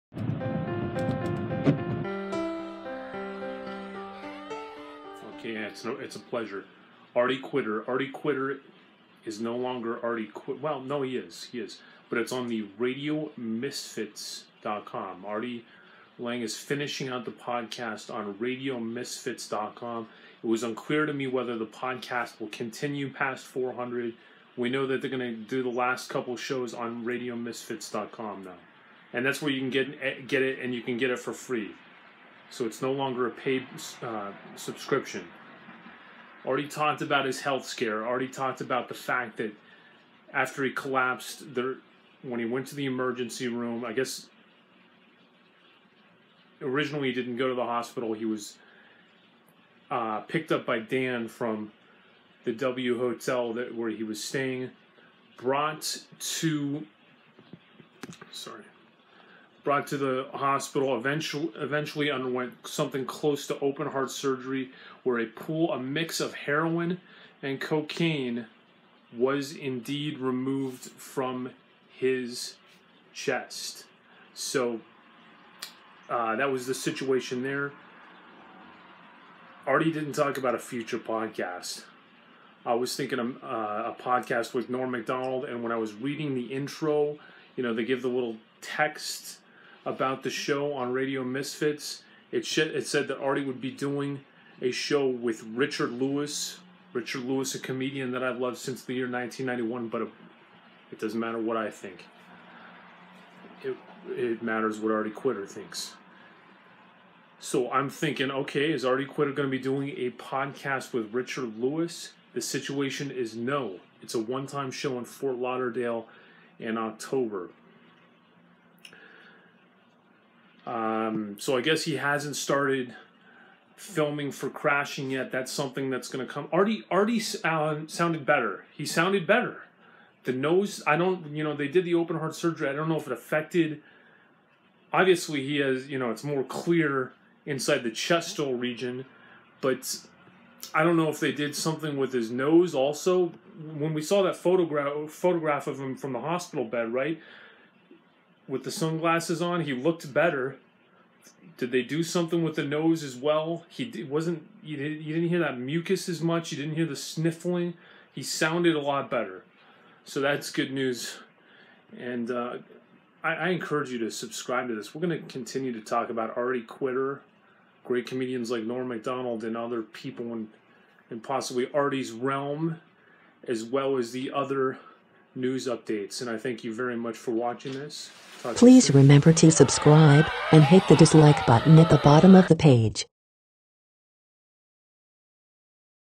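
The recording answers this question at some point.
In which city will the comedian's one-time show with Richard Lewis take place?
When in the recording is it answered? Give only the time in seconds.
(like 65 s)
115 s.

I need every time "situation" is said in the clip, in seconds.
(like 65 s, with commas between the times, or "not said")
76 s, 112 s.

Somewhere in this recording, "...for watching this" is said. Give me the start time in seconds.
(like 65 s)
177 s.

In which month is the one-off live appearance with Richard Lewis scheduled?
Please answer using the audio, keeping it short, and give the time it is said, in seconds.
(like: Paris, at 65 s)
October, at 116 s.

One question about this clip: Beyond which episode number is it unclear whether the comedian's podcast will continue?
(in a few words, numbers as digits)
400.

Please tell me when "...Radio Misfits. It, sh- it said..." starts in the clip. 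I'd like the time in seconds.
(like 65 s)
90 s.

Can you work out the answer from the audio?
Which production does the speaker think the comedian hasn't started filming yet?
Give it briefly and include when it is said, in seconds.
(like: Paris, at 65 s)
Crashing, at 124 s.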